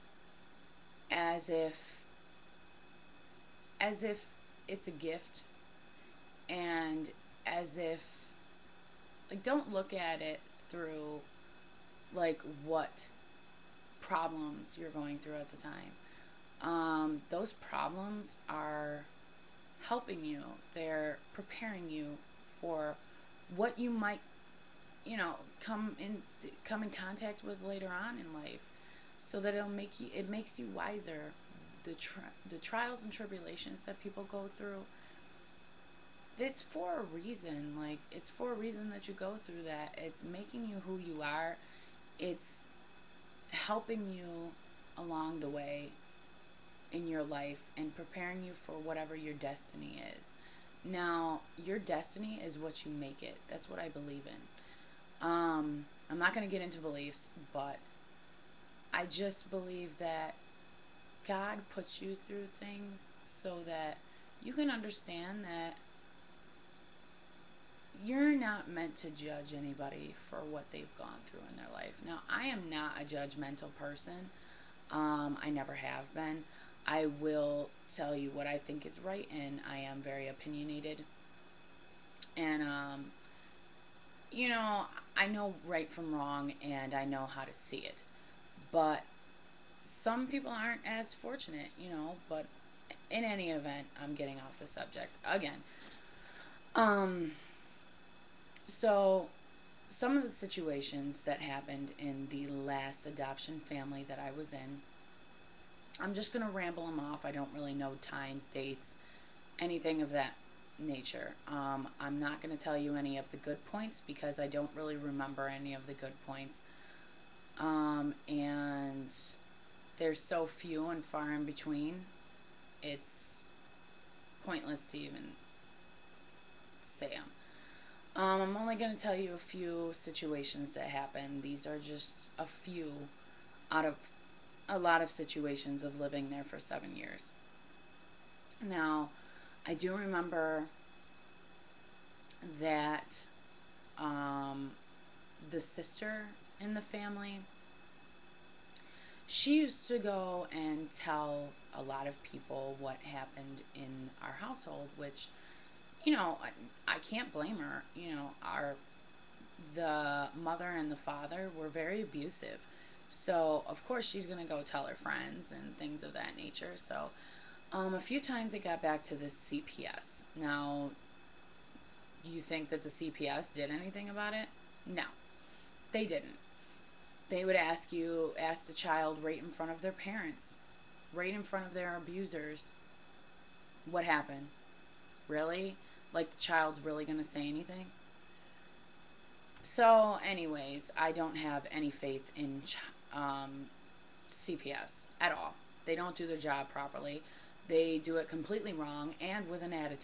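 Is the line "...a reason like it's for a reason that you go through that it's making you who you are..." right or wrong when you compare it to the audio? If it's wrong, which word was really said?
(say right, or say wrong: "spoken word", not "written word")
right.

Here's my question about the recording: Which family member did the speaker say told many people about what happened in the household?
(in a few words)
The sister.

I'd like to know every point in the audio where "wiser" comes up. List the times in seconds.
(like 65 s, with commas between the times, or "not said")
30 s.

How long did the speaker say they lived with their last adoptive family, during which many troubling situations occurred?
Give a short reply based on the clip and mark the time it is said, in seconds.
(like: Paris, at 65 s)
7 years, at 136 s.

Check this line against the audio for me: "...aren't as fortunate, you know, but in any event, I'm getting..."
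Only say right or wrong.
right.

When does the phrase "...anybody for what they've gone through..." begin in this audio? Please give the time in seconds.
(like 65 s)
69 s.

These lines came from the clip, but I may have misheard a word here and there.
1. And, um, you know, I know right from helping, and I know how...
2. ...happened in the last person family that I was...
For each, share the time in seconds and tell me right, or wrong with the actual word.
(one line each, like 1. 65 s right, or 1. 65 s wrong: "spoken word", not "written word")
1. 82 s wrong: "wrong", not "helping"
2. 101 s wrong: "adoption", not "person".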